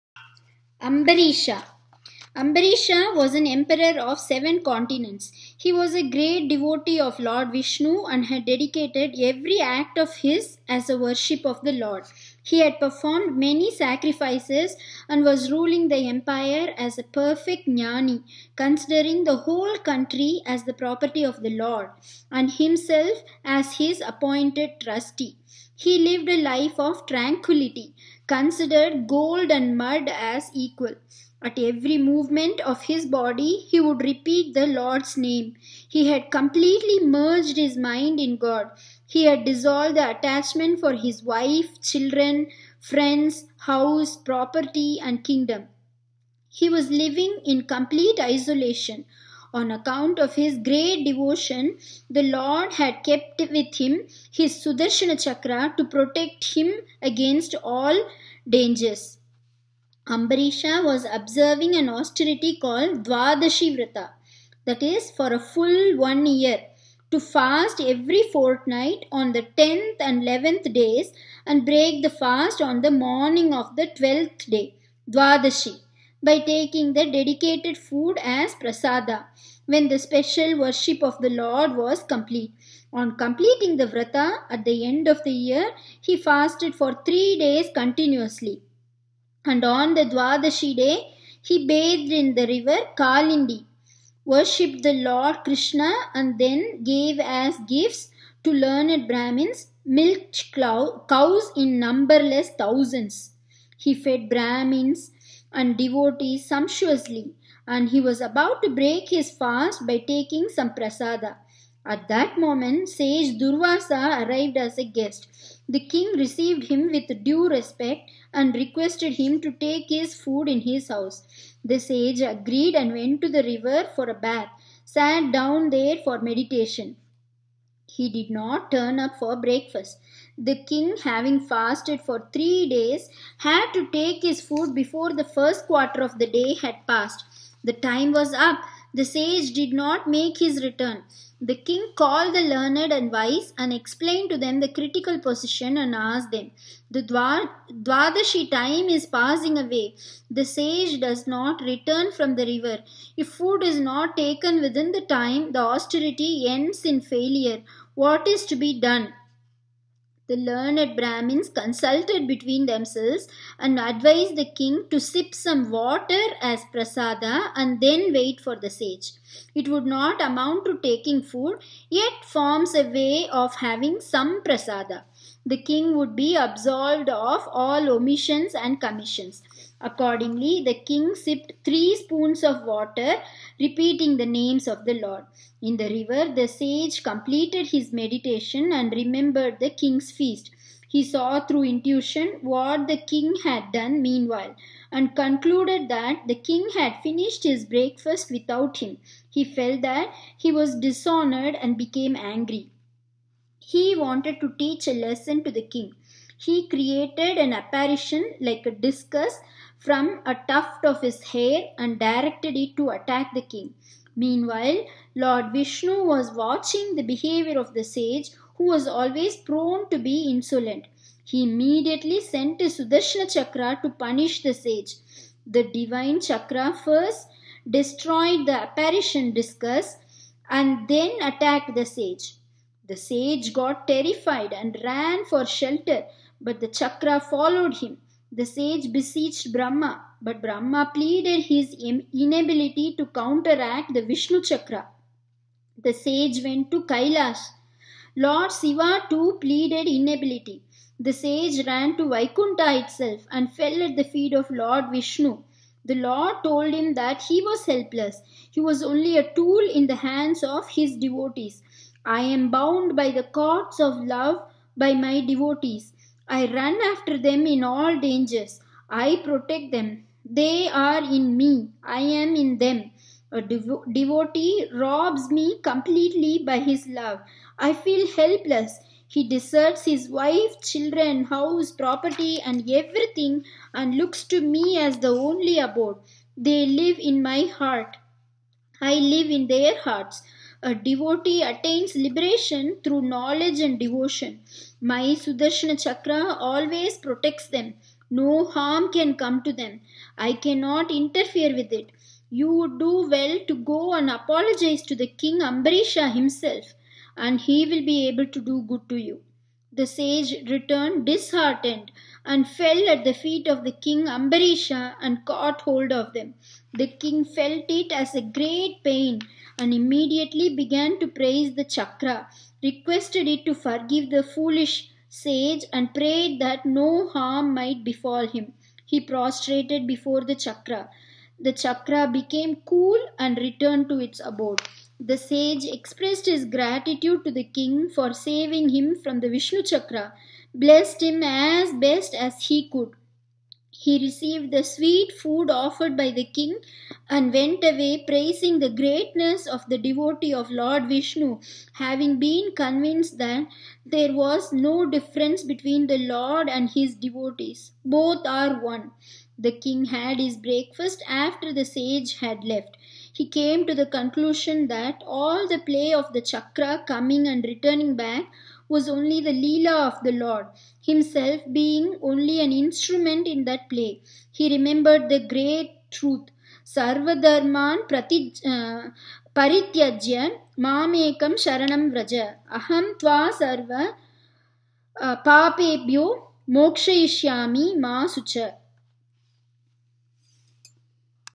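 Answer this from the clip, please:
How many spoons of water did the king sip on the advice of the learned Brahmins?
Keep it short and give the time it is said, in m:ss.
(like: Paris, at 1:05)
3, at 3:01.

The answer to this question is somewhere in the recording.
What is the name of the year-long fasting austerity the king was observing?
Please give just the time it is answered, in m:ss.
1:03.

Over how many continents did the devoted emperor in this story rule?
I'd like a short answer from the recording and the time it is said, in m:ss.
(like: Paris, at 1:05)
7, at 0:04.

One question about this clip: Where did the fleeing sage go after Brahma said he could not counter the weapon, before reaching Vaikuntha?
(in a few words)
Kailash.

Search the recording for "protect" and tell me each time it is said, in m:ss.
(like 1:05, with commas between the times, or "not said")
0:55, 4:29, 4:56.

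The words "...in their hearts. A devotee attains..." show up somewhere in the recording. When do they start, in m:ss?
4:49.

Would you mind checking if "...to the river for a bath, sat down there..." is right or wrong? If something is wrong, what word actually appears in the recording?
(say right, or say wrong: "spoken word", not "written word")
right.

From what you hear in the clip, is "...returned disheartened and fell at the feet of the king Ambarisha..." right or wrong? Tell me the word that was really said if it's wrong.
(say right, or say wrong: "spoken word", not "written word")
right.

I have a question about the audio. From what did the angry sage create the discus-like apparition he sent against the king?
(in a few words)
a tuft of his hair.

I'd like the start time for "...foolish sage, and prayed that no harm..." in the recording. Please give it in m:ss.
5:24.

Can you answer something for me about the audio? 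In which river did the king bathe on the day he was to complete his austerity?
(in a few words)
Kalindi.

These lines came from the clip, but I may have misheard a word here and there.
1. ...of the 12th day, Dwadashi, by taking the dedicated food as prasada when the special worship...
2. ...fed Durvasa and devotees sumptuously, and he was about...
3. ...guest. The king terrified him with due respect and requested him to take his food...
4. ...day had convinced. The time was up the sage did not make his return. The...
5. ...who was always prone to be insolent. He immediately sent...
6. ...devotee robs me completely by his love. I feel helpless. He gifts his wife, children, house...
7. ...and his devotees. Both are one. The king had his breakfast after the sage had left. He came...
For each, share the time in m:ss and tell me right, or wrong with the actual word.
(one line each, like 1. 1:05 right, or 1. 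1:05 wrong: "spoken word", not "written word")
1. 1:13 right
2. 1:43 wrong: "Brahmins", not "Durvasa"
3. 1:54 wrong: "received", not "terrified"
4. 2:16 wrong: "passed", not "convinced"
5. 3:38 right
6. 4:33 wrong: "deserts", not "gifts"
7. 5:56 right.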